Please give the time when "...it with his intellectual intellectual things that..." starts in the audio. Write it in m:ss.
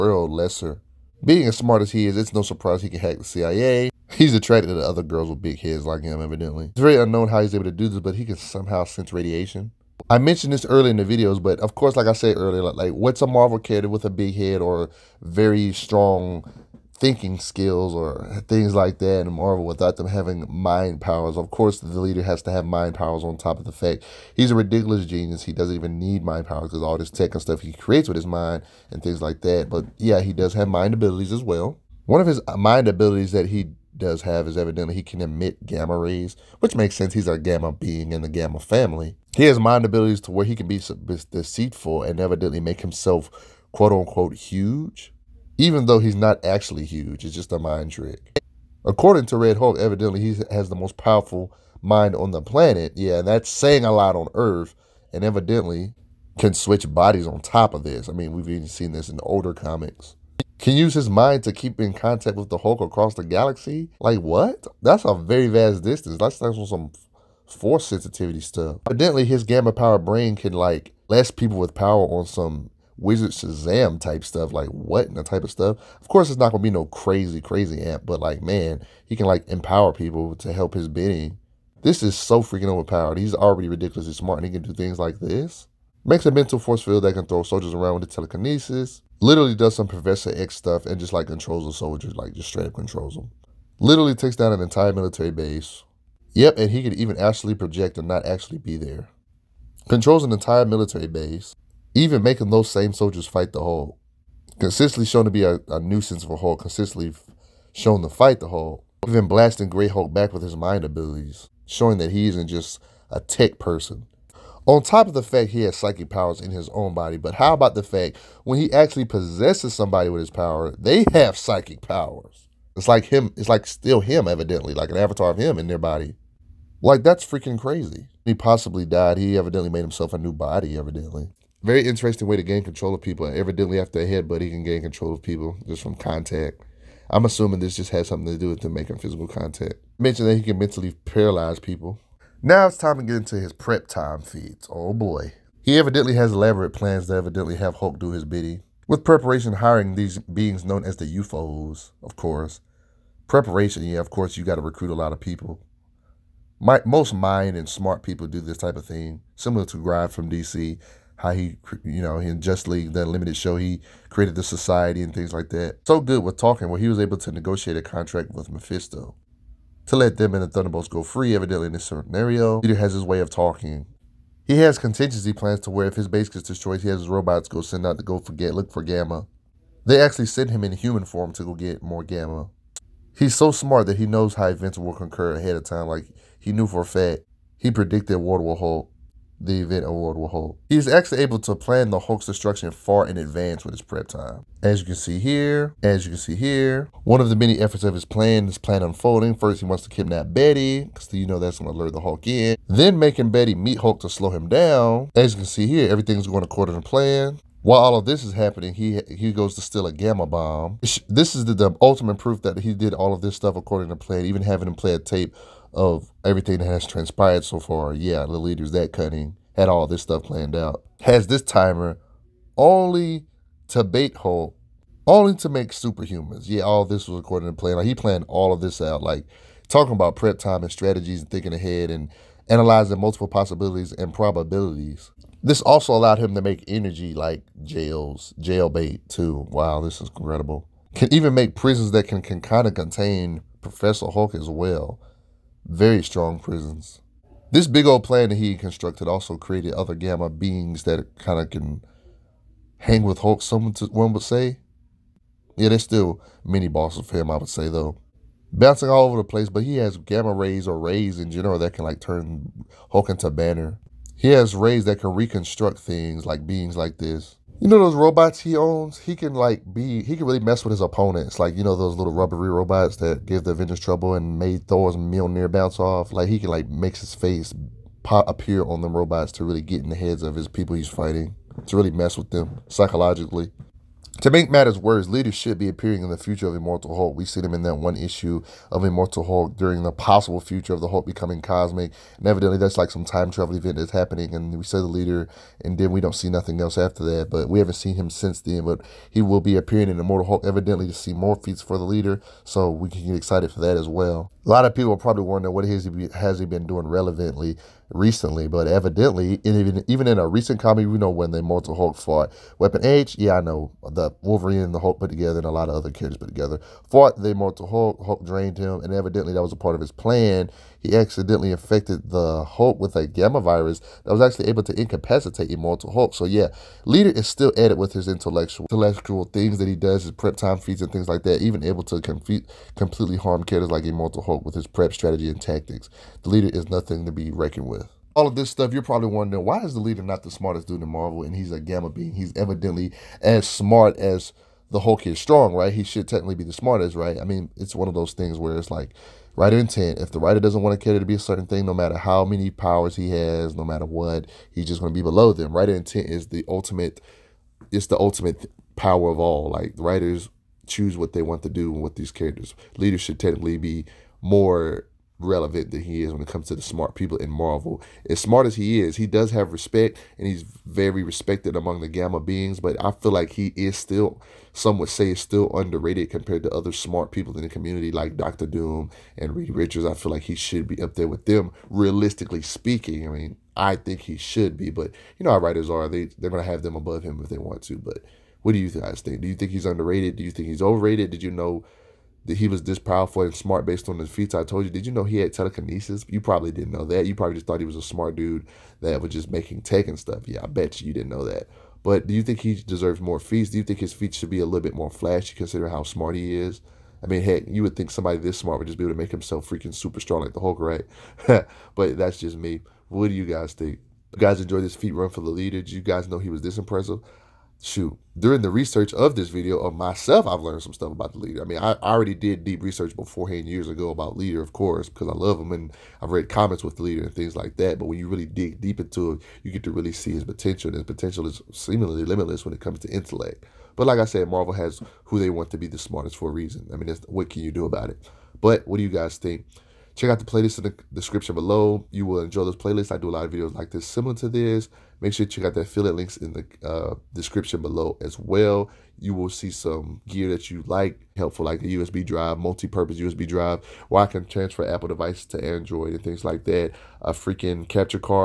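5:27.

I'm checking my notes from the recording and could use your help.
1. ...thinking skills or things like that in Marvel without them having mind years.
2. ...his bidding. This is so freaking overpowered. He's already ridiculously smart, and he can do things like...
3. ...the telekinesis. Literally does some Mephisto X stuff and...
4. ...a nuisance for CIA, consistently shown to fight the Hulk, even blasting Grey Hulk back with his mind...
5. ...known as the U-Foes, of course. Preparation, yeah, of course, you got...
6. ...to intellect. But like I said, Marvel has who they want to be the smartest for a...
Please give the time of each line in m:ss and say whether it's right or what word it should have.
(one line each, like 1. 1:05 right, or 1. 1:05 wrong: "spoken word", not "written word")
1. 0:17 wrong: "powers", not "years"
2. 1:20 right
3. 1:28 wrong: "Professor", not "Mephisto"
4. 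1:45 wrong: "Hulk", not "CIA"
5. 2:30 right
6. 7:12 right.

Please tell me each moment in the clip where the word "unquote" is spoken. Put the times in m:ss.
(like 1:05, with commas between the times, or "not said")
0:43.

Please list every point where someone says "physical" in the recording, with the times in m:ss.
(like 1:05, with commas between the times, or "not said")
2:18.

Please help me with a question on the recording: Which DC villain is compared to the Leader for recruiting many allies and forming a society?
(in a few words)
Grodd.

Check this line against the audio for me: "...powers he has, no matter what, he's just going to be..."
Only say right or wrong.
right.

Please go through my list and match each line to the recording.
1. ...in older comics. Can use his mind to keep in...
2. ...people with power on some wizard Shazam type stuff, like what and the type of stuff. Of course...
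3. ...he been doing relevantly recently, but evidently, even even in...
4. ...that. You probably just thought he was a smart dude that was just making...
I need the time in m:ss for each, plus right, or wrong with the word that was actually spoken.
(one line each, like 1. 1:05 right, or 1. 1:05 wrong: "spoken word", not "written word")
1. 0:59 right
2. 1:11 right
3. 5:06 right
4. 6:36 right.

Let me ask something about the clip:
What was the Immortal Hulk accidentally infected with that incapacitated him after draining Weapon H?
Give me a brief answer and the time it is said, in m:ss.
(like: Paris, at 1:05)
A gamma virus, at 5:23.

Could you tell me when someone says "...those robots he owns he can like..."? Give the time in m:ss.
4:27.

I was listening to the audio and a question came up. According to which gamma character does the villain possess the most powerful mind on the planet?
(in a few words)
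Red Hulk.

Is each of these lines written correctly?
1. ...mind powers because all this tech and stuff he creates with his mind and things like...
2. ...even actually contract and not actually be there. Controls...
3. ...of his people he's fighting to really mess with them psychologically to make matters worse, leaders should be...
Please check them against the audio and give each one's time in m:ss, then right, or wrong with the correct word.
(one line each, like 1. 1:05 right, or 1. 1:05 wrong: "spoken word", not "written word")
1. 0:26 right
2. 1:36 wrong: "project", not "contract"
3. 4:40 right.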